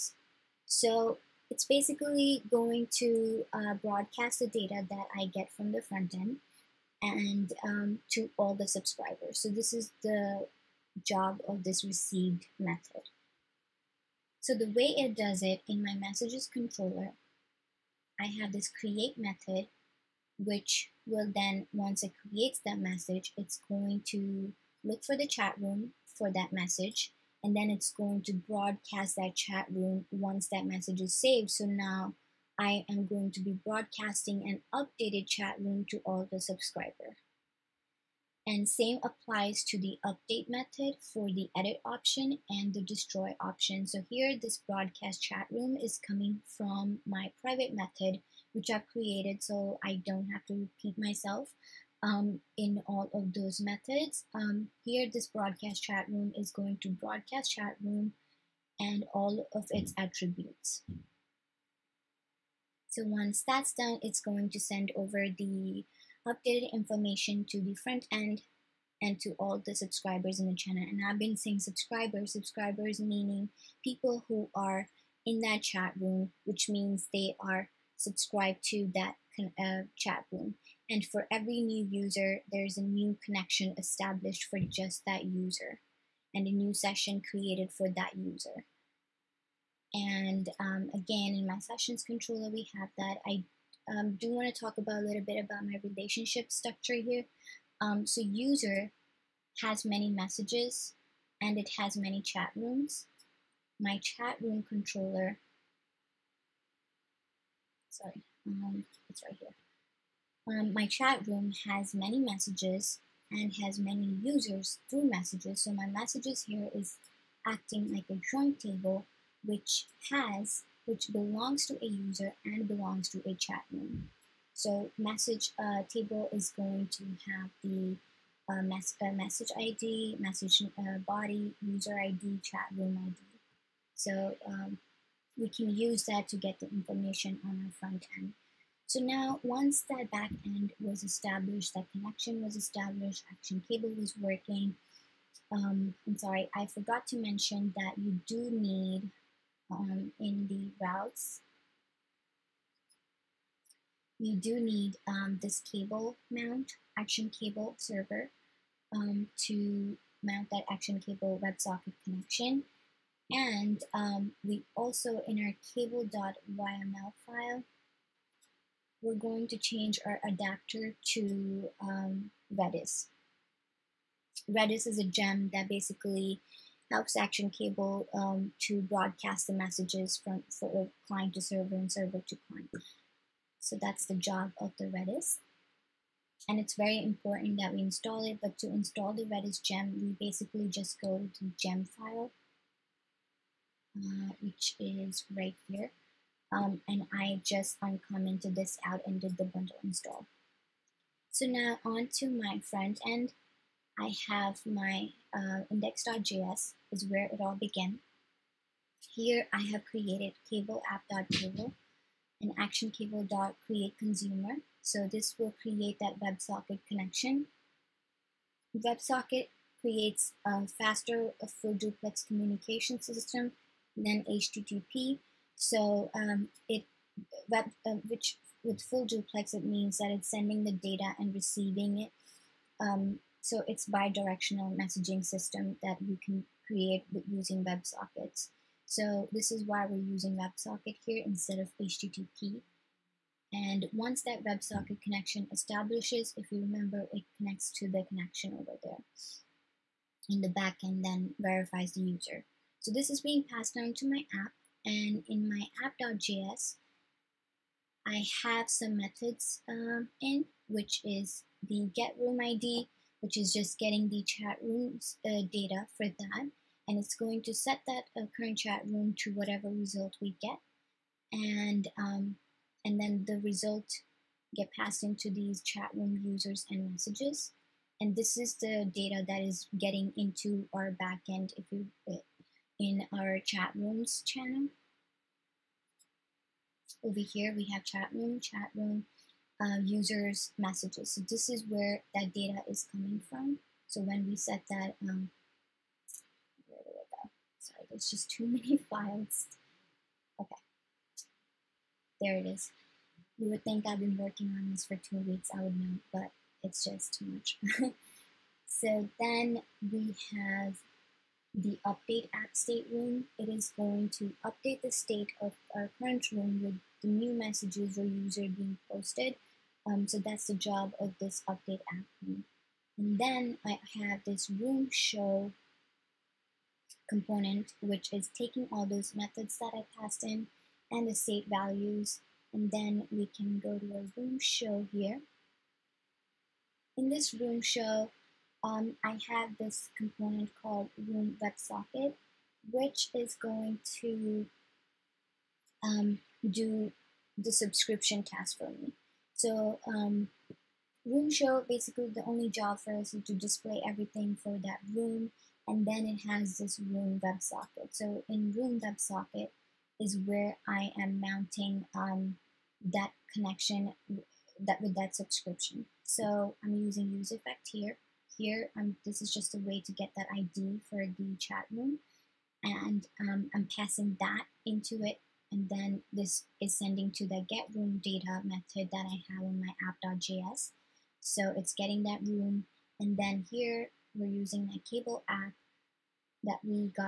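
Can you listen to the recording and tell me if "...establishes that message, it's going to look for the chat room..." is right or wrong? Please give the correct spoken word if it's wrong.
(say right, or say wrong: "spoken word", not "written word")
wrong: "creates", not "establishes".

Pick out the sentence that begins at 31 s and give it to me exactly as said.
So now I am going to be broadcasting an updated chat room to all the subscriber.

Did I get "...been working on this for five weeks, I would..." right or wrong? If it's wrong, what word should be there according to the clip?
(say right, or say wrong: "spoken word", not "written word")
wrong: "two", not "five".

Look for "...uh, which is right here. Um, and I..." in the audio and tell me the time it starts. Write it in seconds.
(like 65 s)
193 s.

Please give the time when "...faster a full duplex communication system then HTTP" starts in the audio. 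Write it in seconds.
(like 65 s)
220 s.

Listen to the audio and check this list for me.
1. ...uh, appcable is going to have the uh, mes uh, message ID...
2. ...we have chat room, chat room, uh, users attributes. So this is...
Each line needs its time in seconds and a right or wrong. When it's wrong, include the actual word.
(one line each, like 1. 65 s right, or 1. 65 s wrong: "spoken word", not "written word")
1. 125 s wrong: "table", not "appcable"
2. 287 s wrong: "messages", not "attributes".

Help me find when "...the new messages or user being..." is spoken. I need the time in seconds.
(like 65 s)
317 s.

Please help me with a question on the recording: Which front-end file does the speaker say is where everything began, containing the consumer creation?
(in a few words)
index.js.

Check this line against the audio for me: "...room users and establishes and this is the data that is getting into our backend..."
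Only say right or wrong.
wrong.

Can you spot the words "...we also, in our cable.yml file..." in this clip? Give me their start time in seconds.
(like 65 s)
164 s.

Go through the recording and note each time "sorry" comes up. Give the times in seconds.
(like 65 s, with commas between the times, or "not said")
107 s, 146 s, 297 s.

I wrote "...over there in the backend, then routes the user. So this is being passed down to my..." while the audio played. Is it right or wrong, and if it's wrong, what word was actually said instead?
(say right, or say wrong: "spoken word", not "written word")
wrong: "verifies", not "routes".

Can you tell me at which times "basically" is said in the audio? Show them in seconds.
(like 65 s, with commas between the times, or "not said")
1 s, 175 s, 190 s, 351 s.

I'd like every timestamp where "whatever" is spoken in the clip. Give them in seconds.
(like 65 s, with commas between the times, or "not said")
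269 s.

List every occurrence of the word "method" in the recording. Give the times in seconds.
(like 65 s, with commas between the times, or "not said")
12 s, 19 s, 40 s, 47 s, 53 s, 258 s, 329 s, 378 s.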